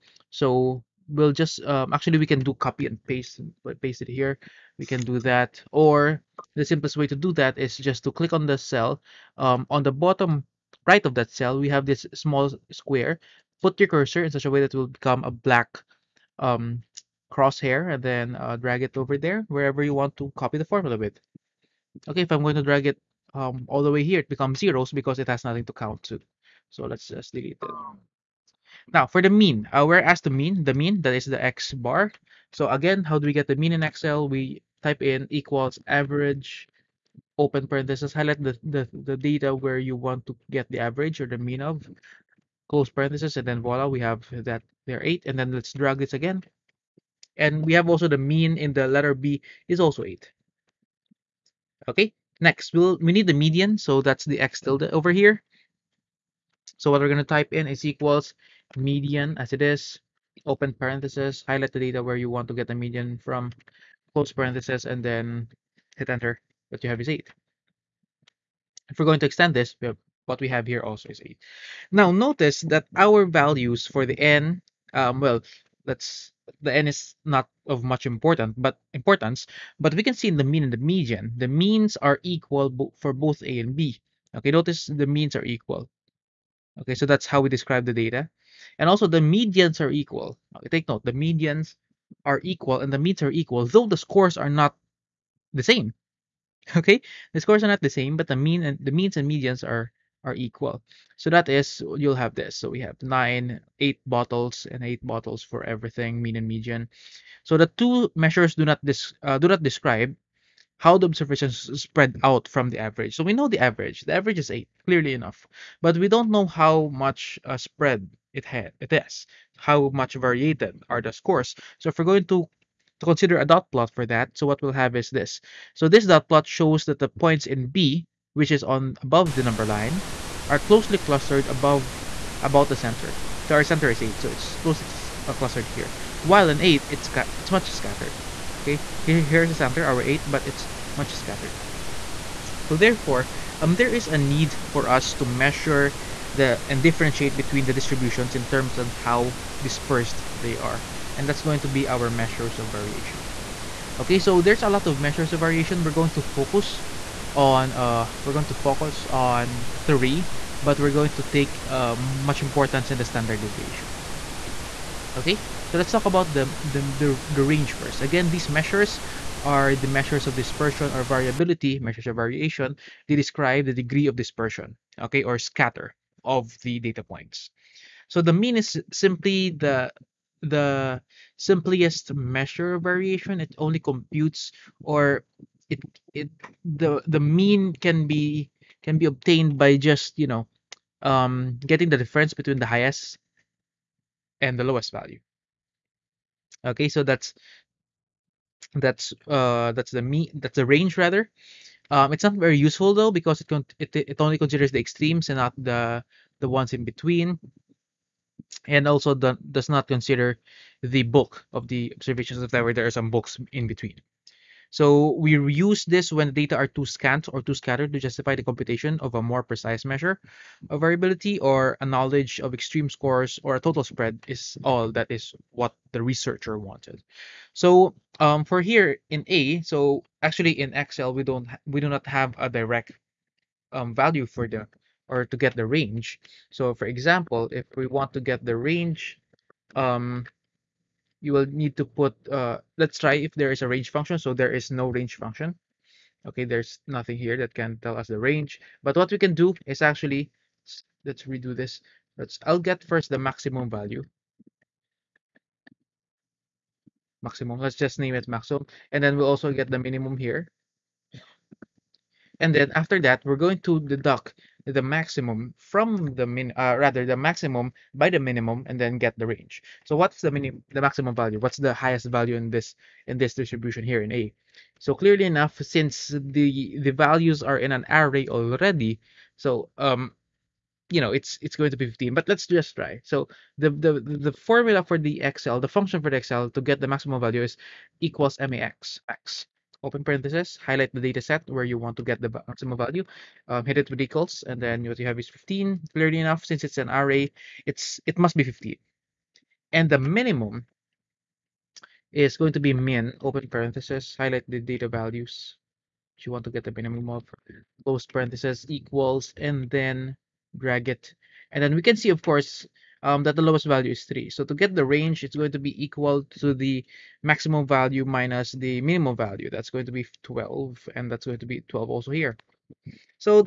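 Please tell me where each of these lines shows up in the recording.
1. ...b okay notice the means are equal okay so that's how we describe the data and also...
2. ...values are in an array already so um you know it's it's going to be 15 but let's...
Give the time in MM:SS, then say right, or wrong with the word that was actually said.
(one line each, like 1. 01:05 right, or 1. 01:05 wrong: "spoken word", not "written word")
1. 01:23 right
2. 04:36 right.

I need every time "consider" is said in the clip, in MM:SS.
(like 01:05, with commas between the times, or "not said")
02:03, 03:24, 03:29.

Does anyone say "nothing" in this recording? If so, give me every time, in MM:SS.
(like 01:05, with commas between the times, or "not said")
00:25, 04:06.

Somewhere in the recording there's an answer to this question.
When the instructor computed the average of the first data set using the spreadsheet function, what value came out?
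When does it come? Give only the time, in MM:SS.
00:43.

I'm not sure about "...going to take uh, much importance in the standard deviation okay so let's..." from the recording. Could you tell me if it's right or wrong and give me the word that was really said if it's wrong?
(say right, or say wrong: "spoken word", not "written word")
right.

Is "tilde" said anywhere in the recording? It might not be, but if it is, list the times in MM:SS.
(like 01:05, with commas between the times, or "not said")
00:54.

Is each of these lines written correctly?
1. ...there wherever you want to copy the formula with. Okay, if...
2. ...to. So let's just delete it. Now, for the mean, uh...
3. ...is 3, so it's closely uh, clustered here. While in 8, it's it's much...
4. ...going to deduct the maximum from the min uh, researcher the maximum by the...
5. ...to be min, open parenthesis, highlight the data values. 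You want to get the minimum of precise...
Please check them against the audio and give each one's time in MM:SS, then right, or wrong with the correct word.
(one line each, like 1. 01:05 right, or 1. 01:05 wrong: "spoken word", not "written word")
1. 00:19 right
2. 00:26 right
3. 02:13 wrong: "8", not "3"
4. 04:23 wrong: "rather", not "researcher"
5. 05:02 wrong: "close", not "precise".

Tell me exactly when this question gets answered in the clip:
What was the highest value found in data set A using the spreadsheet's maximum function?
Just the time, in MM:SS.
04:54.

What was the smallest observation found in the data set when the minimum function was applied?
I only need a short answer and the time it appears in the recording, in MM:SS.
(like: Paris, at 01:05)
3, at 05:13.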